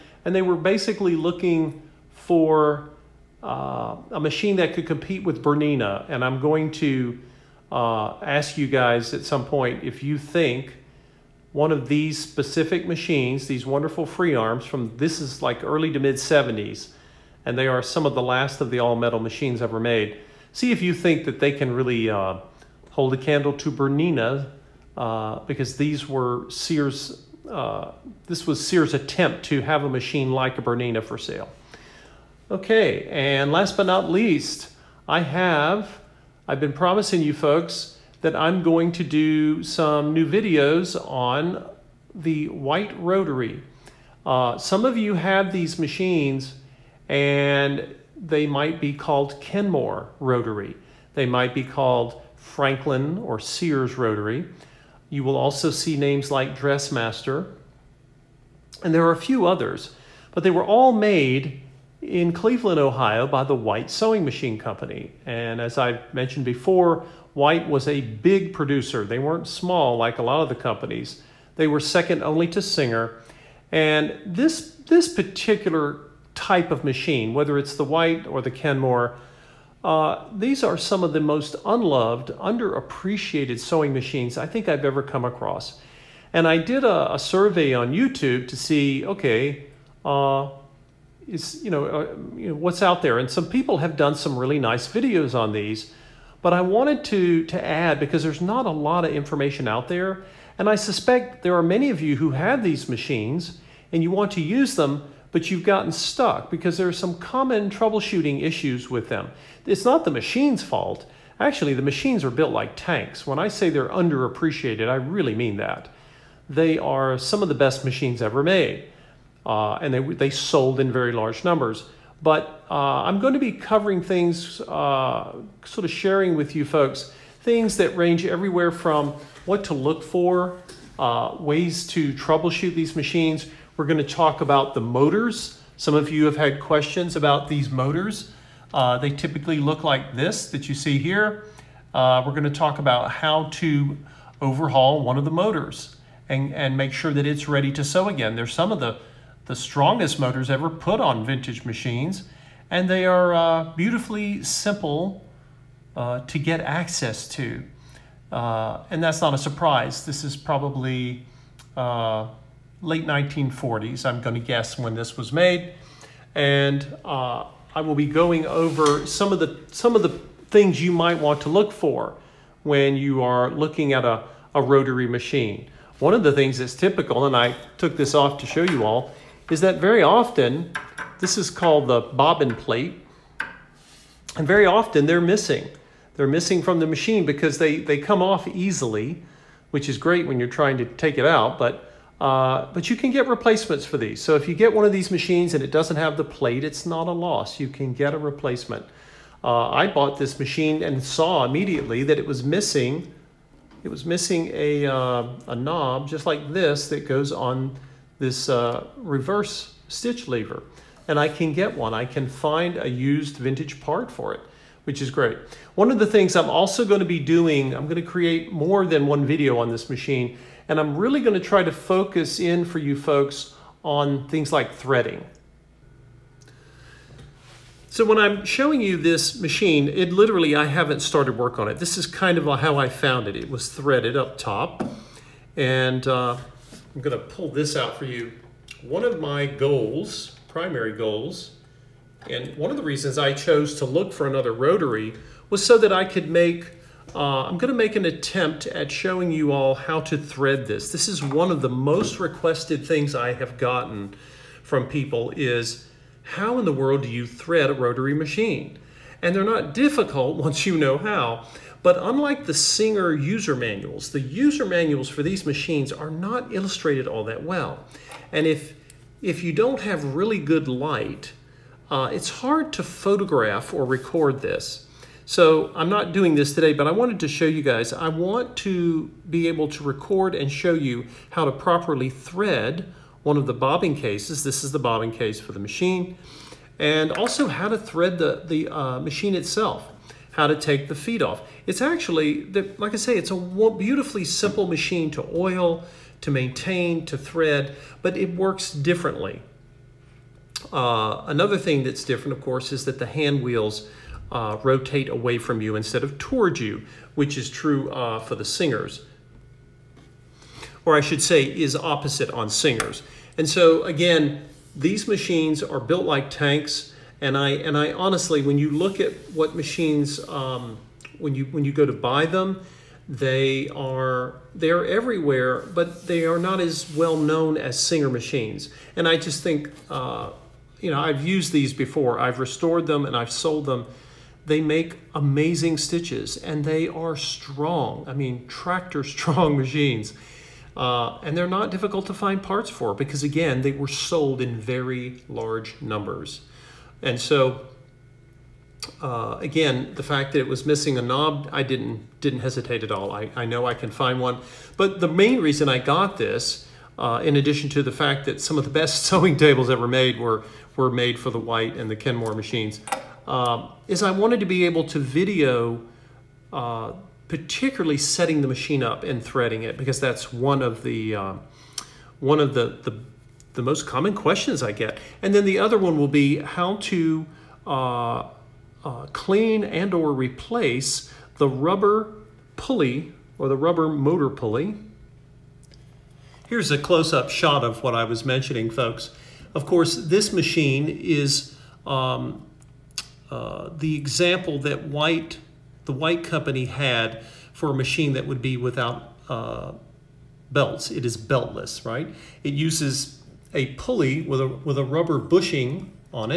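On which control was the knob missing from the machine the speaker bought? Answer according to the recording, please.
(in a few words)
reverse stitch lever.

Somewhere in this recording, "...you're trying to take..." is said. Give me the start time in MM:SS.
03:10.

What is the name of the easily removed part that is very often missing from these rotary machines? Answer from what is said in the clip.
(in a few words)
bobbin plate.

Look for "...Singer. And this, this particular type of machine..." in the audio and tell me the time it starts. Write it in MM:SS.
01:12.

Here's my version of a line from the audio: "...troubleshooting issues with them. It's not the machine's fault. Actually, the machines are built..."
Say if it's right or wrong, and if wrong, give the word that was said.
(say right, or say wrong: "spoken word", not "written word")
right.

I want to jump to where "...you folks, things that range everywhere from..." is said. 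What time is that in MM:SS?
02:06.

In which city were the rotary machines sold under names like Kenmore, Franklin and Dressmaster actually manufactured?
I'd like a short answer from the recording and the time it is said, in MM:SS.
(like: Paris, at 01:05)
Cleveland, Ohio, at 01:02.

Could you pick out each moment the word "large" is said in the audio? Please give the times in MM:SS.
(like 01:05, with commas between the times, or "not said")
02:01, 05:45.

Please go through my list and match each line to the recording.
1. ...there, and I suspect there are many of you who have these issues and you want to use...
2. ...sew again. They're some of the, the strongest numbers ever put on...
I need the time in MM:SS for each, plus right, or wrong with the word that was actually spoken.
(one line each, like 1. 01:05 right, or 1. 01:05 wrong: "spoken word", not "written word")
1. 01:39 wrong: "machines", not "issues"
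2. 02:27 wrong: "motors", not "numbers".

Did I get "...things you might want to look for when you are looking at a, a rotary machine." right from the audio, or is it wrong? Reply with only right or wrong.
right.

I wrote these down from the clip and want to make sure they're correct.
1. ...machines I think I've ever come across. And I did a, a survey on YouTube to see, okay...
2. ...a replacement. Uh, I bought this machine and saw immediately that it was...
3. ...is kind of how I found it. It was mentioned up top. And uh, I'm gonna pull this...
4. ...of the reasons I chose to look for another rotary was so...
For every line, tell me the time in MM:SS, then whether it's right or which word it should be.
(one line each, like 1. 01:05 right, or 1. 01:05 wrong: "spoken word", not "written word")
1. 01:23 right
2. 03:18 right
3. 03:51 wrong: "threaded", not "mentioned"
4. 04:02 right.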